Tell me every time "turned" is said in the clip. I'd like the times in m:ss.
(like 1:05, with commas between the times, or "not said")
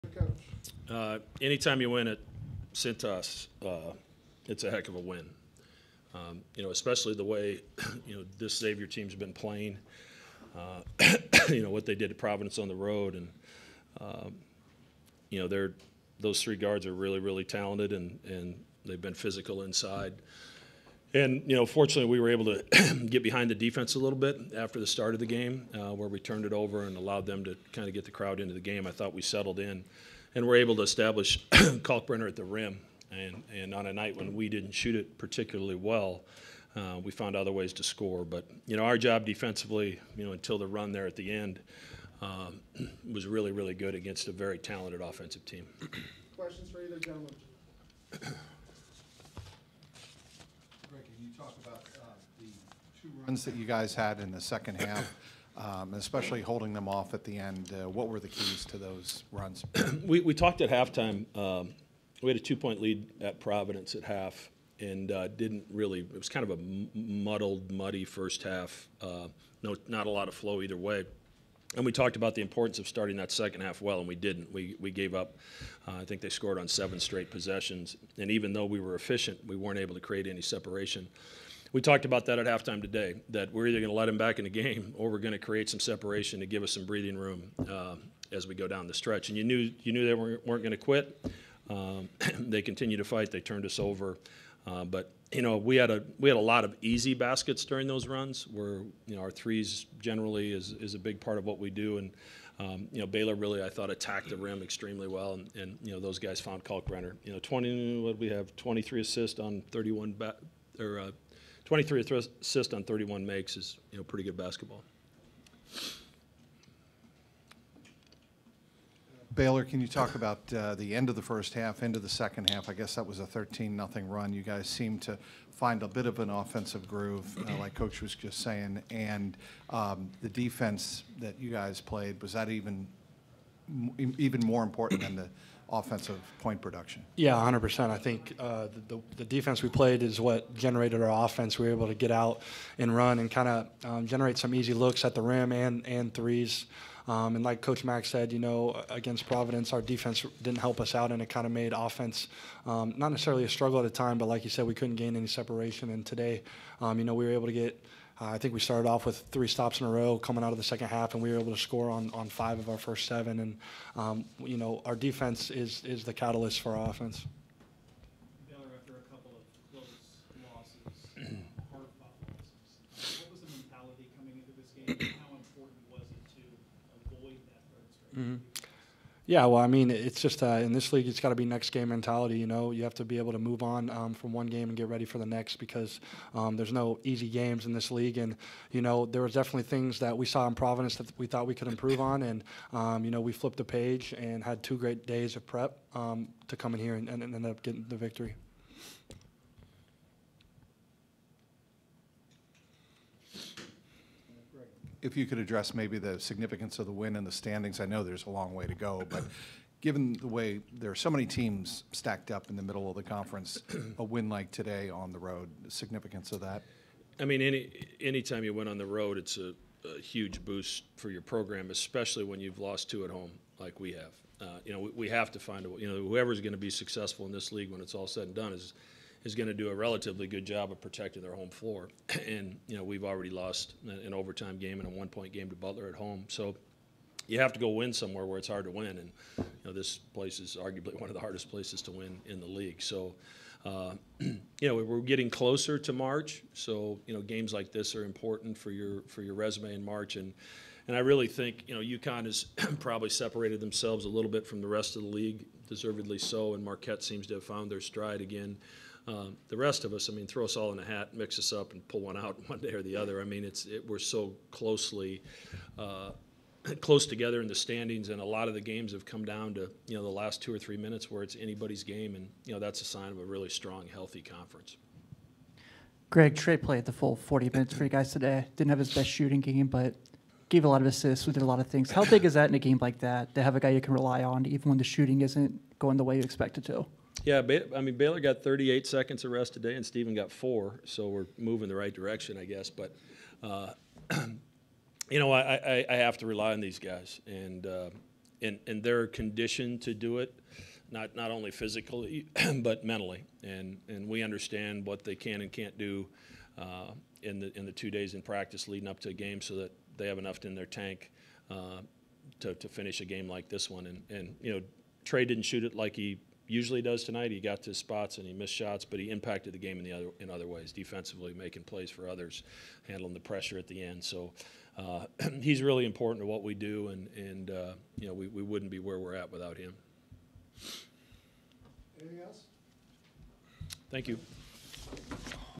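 0:26, 1:33.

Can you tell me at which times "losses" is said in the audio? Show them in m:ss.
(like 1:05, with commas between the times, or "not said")
2:49, 2:54.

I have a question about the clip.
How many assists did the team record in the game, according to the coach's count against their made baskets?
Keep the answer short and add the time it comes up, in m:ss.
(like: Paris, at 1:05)
23, at 1:51.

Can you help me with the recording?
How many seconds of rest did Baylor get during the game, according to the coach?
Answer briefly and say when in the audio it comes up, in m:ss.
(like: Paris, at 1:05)
38, at 4:48.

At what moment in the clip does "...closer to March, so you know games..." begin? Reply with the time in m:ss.
4:05.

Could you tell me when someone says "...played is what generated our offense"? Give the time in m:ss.
2:19.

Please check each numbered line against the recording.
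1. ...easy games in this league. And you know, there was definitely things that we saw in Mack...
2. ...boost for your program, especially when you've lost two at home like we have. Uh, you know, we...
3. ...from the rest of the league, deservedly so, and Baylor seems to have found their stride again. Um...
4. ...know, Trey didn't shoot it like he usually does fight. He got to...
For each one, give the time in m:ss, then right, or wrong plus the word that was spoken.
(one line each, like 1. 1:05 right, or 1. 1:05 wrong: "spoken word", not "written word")
1. 3:07 wrong: "Providence", not "Mack"
2. 3:40 right
3. 4:14 wrong: "Marquette", not "Baylor"
4. 5:14 wrong: "tonight", not "fight".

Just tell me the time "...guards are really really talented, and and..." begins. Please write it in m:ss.
0:16.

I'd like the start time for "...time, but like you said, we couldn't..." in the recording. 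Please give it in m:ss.
2:33.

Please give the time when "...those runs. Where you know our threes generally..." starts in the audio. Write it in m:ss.
1:37.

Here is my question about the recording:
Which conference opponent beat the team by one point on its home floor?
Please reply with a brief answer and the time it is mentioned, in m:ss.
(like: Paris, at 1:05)
Butler, at 3:55.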